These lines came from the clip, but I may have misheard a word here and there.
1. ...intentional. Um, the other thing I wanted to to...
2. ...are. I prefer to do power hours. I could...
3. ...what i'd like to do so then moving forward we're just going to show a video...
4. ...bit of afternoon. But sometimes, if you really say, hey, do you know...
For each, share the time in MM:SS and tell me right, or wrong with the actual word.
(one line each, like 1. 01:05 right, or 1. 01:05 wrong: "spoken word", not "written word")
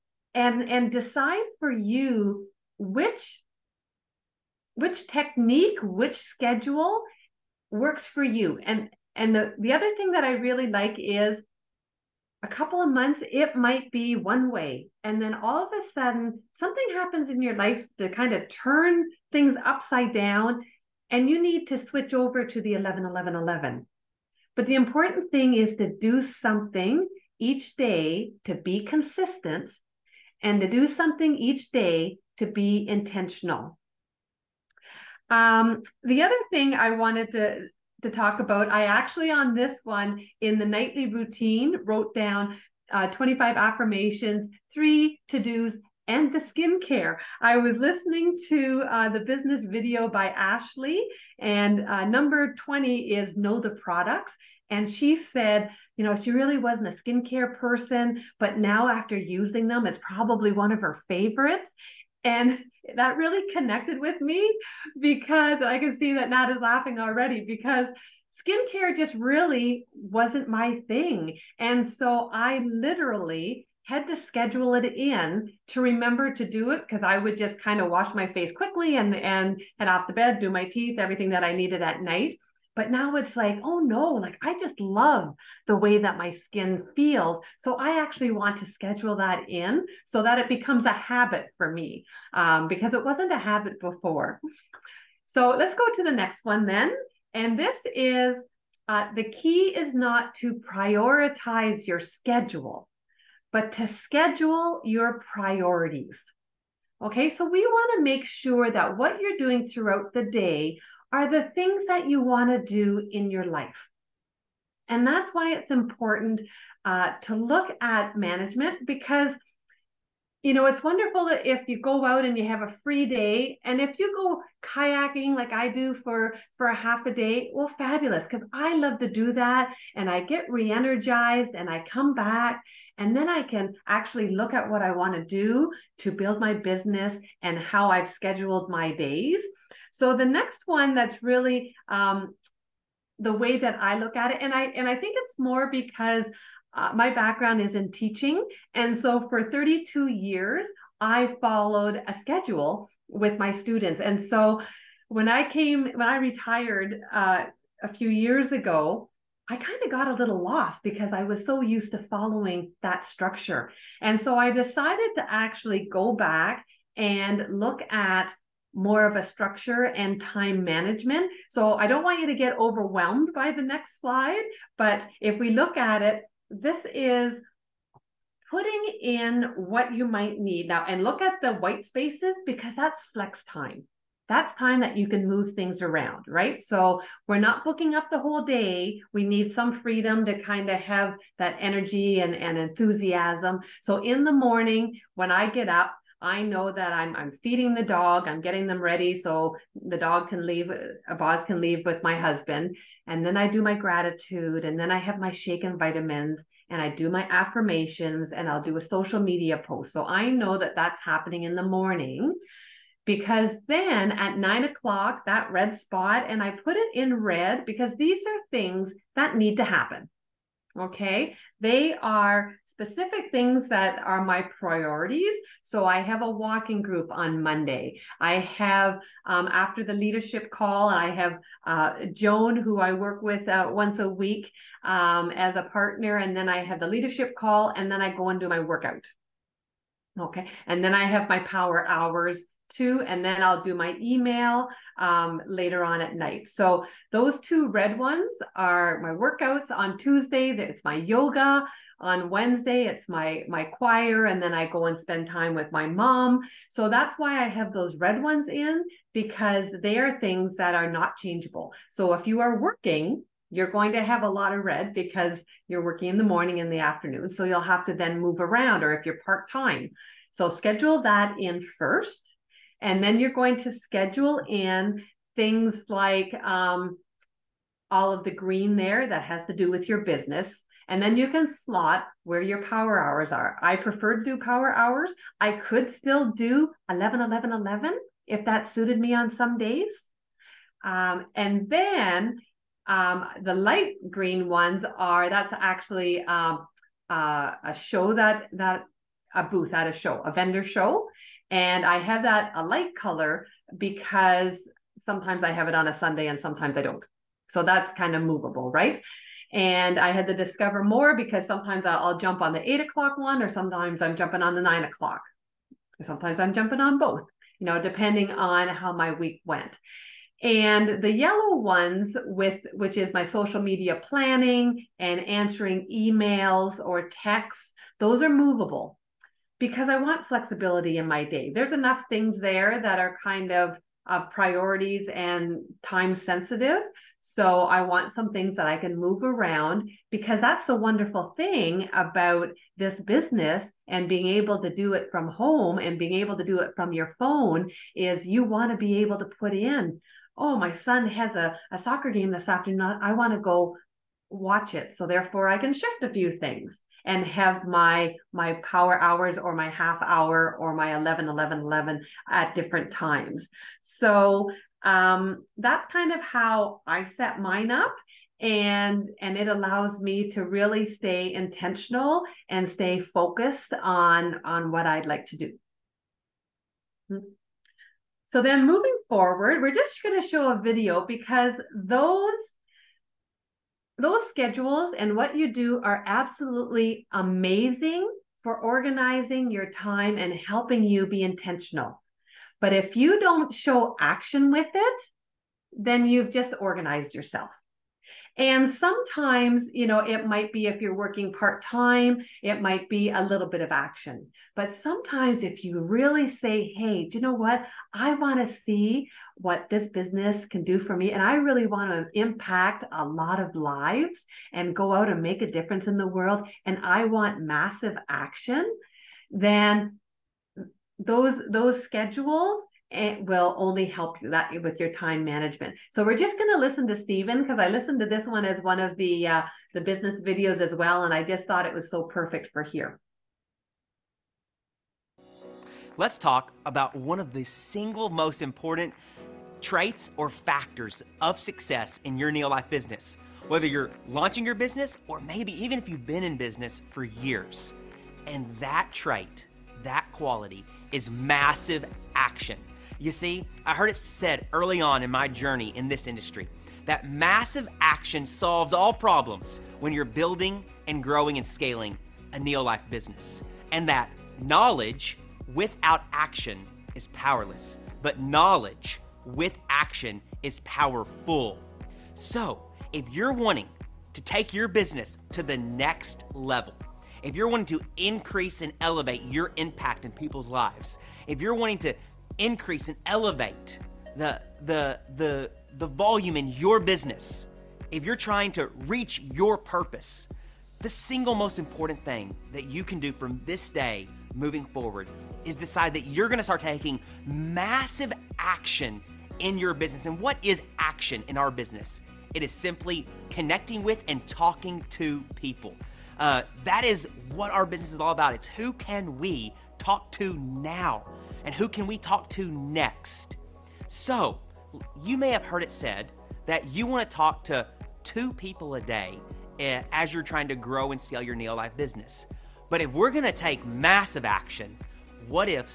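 1. 00:32 right
2. 04:43 right
3. 06:14 right
4. 06:43 wrong: "action", not "afternoon".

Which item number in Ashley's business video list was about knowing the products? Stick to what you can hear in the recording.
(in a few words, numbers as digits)
20.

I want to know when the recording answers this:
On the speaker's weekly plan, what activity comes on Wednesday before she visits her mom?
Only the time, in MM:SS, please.
04:13.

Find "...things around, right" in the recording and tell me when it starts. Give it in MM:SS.
03:05.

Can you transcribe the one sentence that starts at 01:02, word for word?
And that really connected with me because I can see that Nat is laughing already because skincare just really wasn't my thing.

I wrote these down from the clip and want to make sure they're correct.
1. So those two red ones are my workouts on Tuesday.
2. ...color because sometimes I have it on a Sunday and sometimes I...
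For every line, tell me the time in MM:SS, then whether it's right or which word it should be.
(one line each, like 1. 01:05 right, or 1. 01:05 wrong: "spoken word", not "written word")
1. 04:06 right
2. 05:02 right.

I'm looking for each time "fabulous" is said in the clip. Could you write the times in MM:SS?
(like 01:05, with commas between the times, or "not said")
02:07.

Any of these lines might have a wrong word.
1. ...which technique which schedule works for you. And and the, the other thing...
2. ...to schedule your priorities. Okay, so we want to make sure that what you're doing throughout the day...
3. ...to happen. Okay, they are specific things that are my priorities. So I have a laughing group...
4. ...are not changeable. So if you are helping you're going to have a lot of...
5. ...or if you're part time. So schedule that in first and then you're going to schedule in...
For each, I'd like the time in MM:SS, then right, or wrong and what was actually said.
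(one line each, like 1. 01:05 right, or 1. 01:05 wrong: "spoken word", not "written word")
1. 00:04 right
2. 01:43 right
3. 03:39 wrong: "walking", not "laughing"
4. 04:20 wrong: "working", not "helping"
5. 04:28 right.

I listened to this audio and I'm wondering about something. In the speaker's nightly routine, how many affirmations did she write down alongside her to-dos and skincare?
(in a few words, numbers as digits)
25.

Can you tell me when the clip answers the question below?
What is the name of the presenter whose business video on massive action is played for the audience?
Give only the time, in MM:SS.
07:06.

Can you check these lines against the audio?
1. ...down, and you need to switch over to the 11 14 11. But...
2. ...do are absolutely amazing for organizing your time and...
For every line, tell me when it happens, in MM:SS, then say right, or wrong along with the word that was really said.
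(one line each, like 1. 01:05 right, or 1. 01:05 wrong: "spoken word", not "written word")
1. 00:20 wrong: "11", not "14"
2. 06:25 right.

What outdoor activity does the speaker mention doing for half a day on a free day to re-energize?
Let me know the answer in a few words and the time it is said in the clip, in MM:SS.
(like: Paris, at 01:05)
Kayaking, at 02:04.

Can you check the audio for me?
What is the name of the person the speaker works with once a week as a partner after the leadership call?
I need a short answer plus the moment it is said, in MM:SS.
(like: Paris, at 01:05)
Joan, at 03:52.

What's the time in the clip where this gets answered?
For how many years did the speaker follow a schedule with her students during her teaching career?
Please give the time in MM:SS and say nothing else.
02:29.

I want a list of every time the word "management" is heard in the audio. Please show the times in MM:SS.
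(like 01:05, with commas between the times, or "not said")
01:58, 02:50, 07:05.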